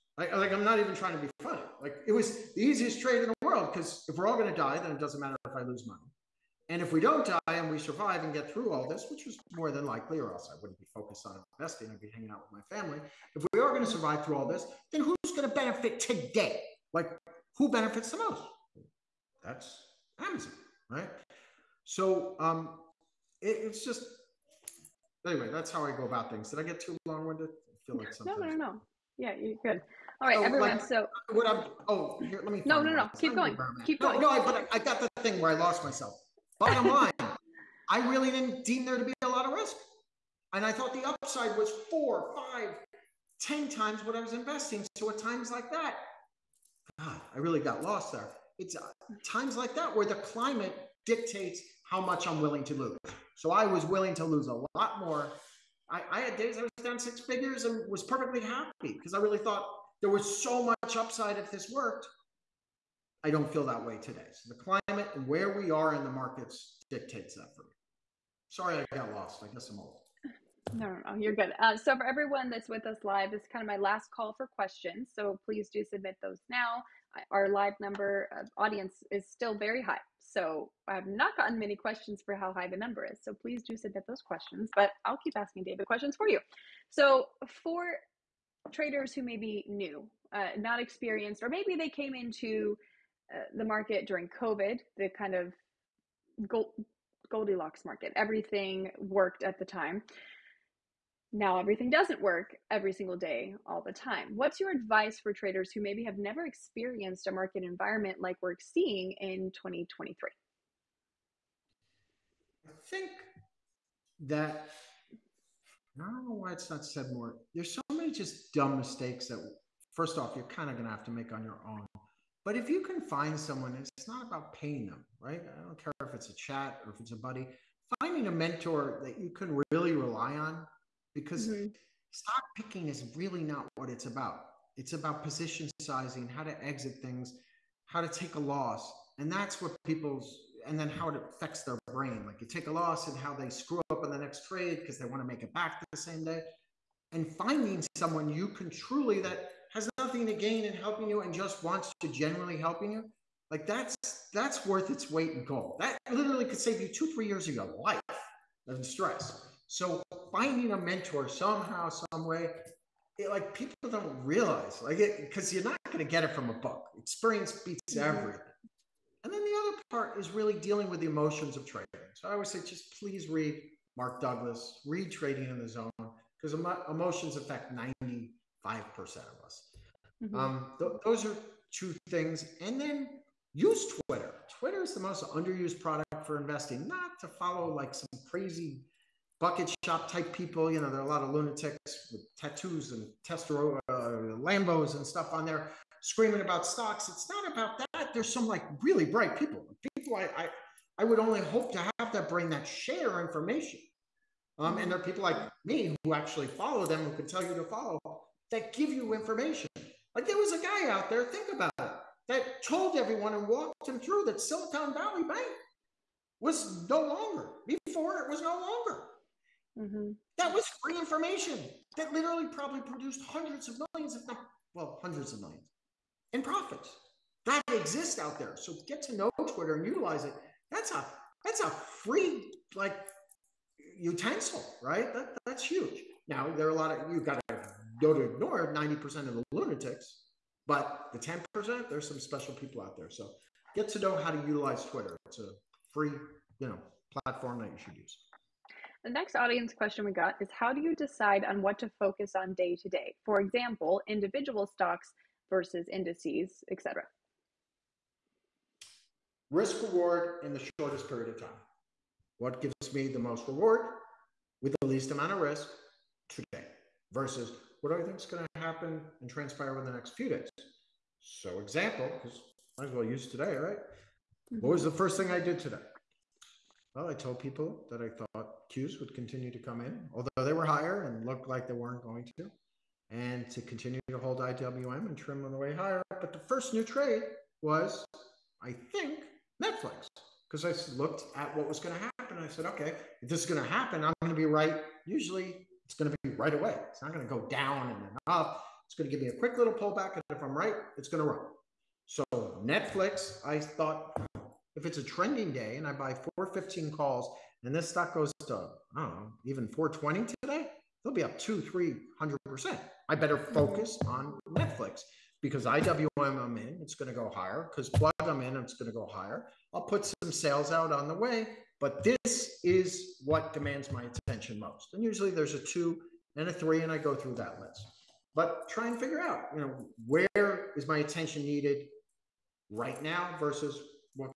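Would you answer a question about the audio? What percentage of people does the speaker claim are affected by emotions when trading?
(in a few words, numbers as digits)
95%.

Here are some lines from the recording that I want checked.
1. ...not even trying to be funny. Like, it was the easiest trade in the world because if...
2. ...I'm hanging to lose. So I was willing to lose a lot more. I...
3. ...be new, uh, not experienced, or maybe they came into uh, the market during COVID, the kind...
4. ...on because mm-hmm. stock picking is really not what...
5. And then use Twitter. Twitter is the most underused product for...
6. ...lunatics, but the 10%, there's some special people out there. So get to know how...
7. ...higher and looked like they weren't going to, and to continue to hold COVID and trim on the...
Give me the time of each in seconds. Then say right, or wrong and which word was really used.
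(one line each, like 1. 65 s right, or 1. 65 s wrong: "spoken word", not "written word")
1. 0 s right
2. 52 s wrong: "willing", not "hanging"
3. 89 s right
4. 130 s right
5. 182 s right
6. 239 s right
7. 280 s wrong: "IWM", not "COVID".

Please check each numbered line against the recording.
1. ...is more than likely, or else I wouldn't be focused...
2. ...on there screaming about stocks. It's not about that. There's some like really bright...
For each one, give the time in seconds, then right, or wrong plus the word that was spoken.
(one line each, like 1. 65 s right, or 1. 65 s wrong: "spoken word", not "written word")
1. 9 s right
2. 195 s right.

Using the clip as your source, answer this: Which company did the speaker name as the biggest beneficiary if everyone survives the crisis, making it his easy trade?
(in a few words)
Amazon.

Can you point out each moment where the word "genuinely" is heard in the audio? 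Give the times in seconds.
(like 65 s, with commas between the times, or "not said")
152 s.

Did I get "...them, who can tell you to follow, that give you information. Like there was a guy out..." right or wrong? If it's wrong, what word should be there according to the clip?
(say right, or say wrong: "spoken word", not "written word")
right.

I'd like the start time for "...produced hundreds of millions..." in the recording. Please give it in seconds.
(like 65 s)
222 s.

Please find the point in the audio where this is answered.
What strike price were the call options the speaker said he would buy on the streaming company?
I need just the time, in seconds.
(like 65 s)
306 s.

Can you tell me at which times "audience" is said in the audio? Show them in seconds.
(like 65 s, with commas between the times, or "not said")
78 s, 249 s.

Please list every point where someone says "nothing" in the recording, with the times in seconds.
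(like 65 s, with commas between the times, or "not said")
149 s.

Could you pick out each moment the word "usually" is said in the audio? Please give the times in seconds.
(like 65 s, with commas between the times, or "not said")
295 s, 325 s.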